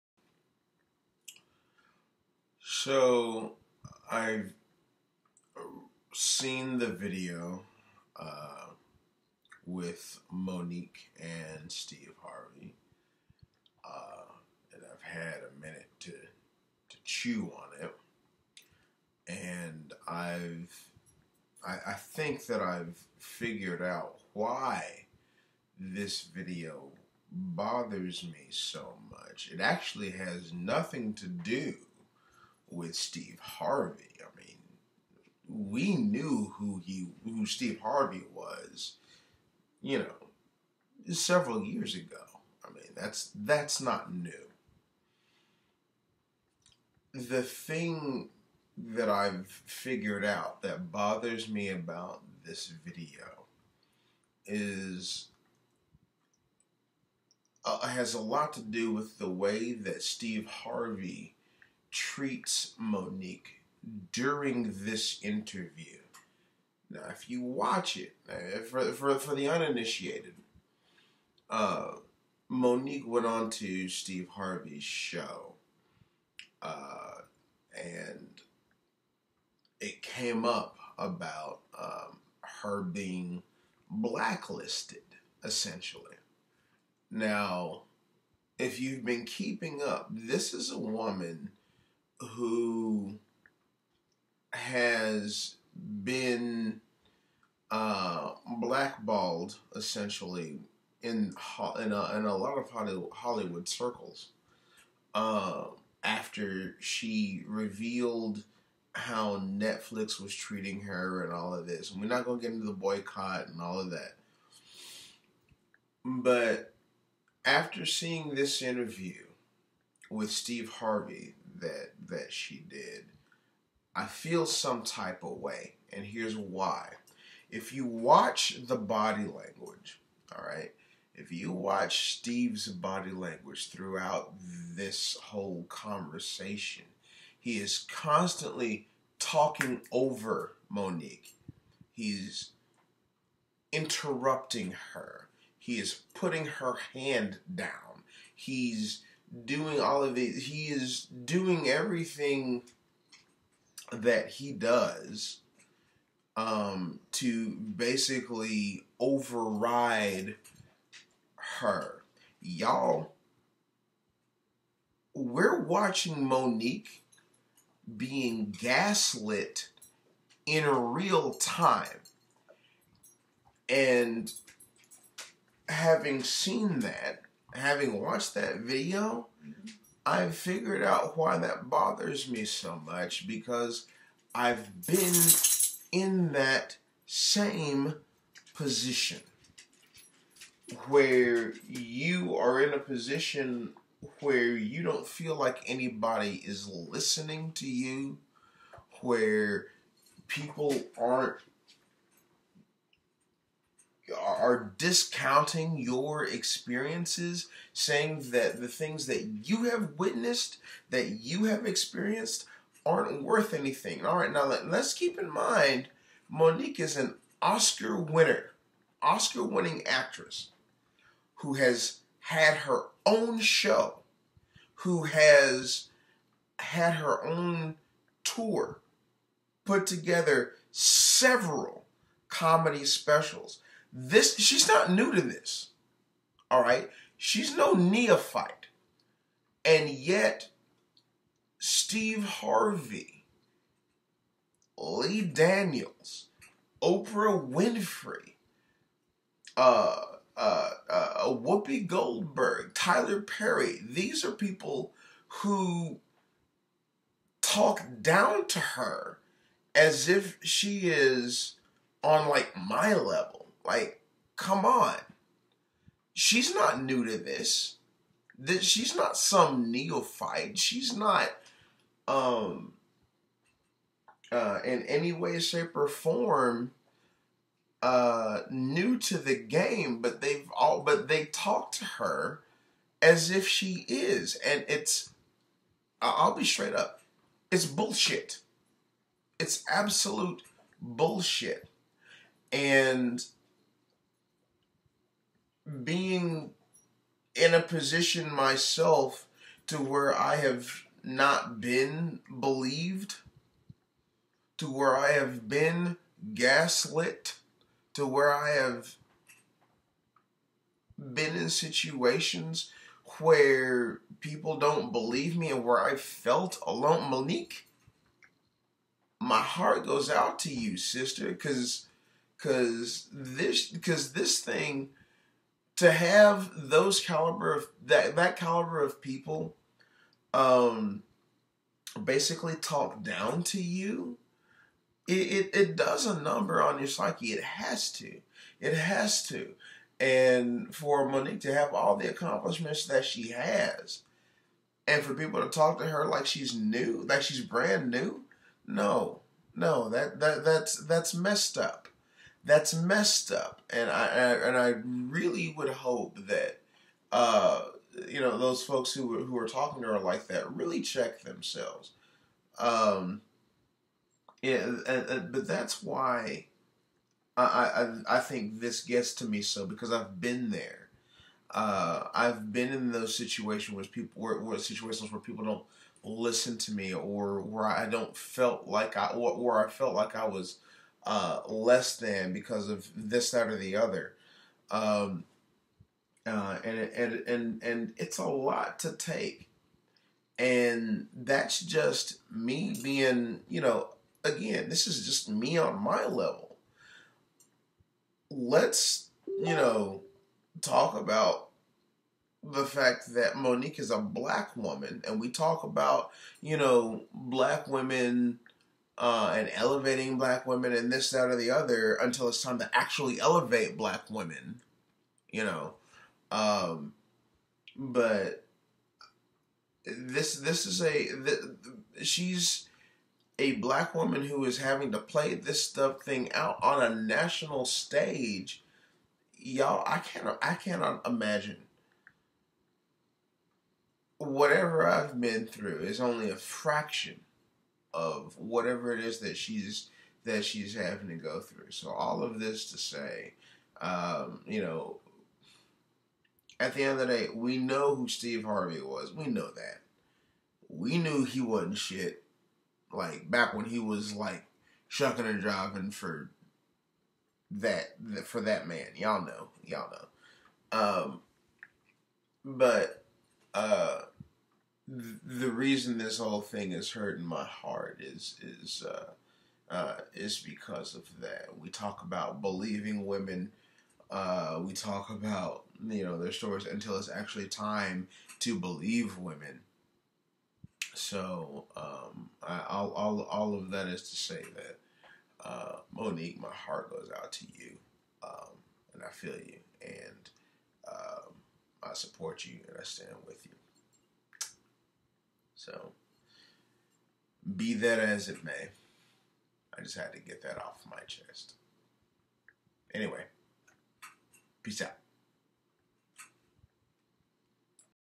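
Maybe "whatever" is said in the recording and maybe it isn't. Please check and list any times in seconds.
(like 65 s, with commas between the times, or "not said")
434 s, 438 s.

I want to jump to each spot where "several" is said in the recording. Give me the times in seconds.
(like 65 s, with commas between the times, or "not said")
41 s, 230 s.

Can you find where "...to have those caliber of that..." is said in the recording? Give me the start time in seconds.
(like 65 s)
325 s.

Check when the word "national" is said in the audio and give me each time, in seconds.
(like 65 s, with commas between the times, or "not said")
426 s.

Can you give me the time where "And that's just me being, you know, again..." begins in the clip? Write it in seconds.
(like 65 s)
390 s.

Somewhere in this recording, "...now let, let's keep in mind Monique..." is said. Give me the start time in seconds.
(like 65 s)
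214 s.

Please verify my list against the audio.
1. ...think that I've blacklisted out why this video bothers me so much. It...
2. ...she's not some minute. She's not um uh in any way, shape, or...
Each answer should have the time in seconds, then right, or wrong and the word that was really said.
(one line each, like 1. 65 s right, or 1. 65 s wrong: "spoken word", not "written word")
1. 21 s wrong: "figured", not "blacklisted"
2. 268 s wrong: "neophyte", not "minute".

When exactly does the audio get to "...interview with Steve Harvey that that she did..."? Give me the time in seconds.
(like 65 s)
118 s.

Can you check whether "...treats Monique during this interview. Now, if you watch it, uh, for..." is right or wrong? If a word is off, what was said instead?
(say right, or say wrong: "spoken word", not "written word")
right.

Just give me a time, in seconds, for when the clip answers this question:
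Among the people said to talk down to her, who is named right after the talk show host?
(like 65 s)
244 s.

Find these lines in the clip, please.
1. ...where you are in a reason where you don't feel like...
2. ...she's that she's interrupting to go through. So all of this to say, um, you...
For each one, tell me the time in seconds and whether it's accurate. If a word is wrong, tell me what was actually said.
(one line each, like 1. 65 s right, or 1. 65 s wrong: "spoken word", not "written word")
1. 190 s wrong: "position", not "reason"
2. 439 s wrong: "having", not "interrupting".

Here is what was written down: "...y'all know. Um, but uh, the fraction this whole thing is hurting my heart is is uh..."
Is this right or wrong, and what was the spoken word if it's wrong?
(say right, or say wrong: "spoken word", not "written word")
wrong: "reason", not "fraction".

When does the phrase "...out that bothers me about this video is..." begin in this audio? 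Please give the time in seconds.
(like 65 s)
50 s.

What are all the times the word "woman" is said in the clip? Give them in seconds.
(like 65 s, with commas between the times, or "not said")
90 s, 404 s, 423 s.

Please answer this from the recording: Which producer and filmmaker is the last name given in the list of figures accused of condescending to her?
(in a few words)
Tyler Perry.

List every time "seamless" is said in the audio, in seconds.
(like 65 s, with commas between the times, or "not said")
not said.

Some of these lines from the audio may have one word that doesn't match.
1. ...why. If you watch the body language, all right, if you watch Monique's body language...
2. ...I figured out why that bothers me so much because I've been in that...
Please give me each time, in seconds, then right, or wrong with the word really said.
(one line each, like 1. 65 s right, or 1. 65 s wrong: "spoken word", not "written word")
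1. 126 s wrong: "Steve", not "Monique"
2. 180 s right.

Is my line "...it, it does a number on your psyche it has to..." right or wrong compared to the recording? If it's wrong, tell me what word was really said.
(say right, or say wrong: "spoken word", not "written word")
right.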